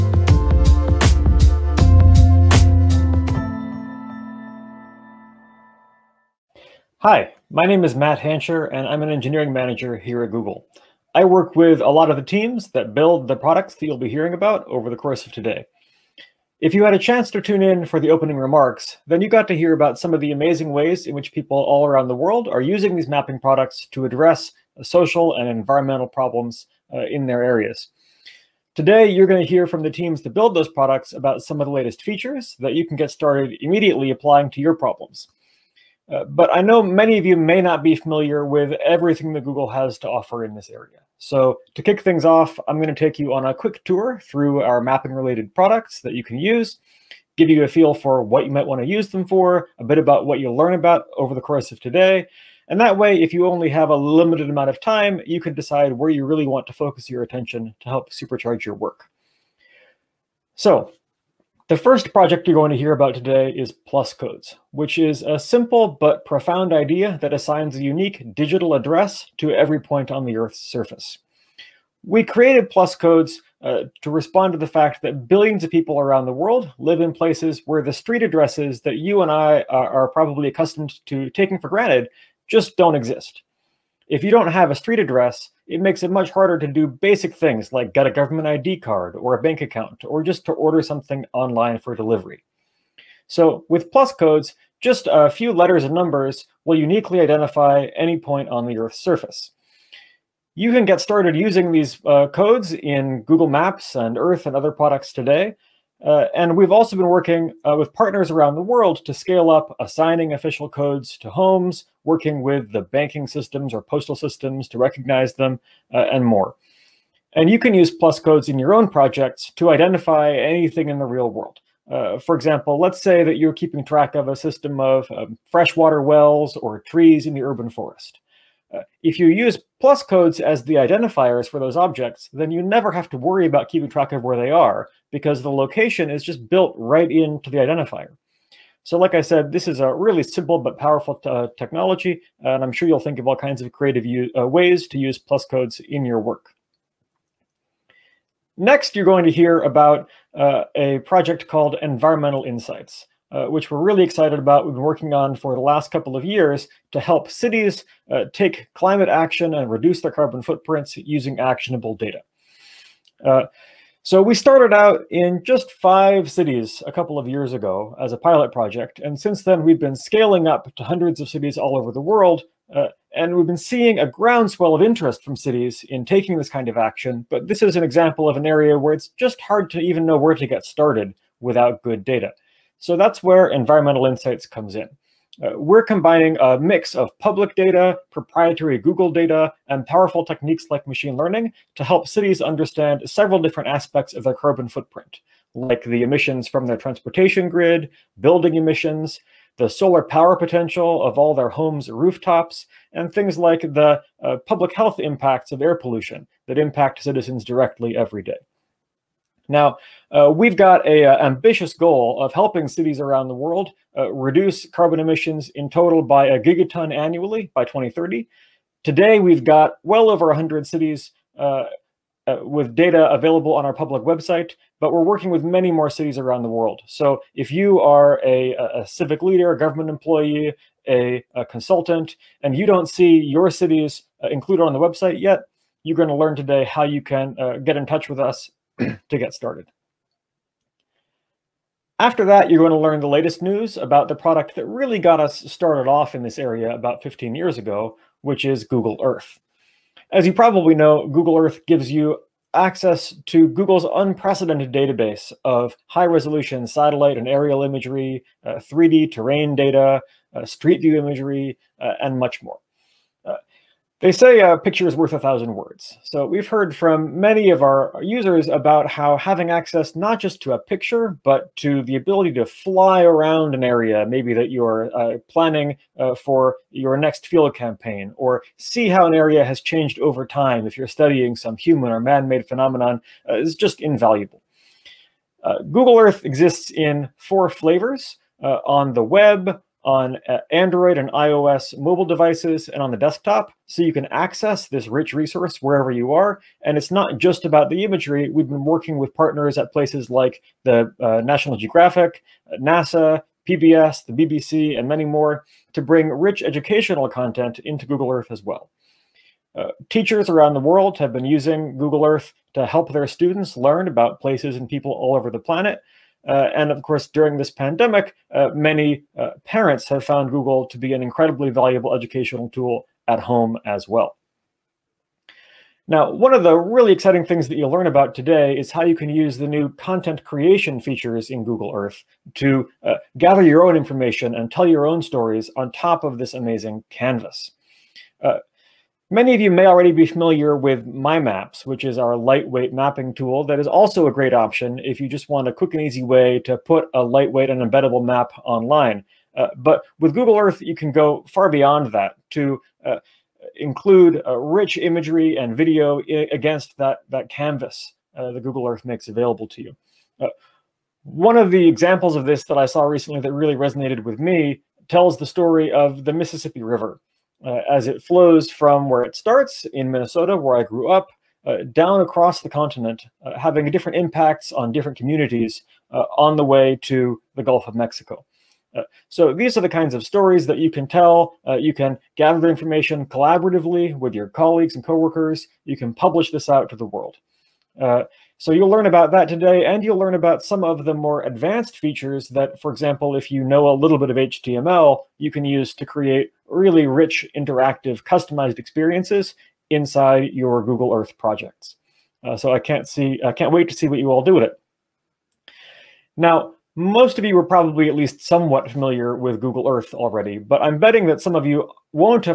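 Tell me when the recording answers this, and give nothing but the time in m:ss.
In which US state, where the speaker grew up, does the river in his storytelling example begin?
6:09.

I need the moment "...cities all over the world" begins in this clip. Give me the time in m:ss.
2:51.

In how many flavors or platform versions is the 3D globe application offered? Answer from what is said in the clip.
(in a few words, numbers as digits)
4.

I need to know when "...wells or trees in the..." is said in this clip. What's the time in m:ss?
2:06.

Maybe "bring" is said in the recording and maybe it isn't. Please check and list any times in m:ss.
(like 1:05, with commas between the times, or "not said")
5:05.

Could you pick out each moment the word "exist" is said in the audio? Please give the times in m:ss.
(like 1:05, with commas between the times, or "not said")
1:22, 4:46.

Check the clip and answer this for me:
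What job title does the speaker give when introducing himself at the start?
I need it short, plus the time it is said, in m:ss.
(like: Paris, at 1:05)
Engineering manager, at 0:09.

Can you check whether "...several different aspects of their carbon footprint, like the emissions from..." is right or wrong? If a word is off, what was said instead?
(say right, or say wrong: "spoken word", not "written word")
right.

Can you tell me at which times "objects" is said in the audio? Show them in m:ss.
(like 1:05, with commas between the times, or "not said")
2:11.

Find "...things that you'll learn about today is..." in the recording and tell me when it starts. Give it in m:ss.
5:27.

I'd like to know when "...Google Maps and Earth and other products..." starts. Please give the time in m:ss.
1:43.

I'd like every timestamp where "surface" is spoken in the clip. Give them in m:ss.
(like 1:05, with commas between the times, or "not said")
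1:10, 1:38.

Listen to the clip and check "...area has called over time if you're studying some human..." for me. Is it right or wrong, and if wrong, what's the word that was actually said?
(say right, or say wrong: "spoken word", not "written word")
wrong: "changed", not "called".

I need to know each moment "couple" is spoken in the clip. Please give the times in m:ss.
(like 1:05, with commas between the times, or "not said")
2:35, 2:46.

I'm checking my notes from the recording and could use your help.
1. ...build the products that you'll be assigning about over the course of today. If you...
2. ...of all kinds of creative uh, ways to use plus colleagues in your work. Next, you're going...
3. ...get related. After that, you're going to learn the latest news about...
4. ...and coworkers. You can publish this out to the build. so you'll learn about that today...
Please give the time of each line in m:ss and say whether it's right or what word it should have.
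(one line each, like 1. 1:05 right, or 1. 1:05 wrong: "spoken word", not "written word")
1. 0:12 wrong: "hearing", not "assigning"
2. 2:23 wrong: "codes", not "colleagues"
3. 3:59 wrong: "started", not "related"
4. 6:24 wrong: "world", not "build".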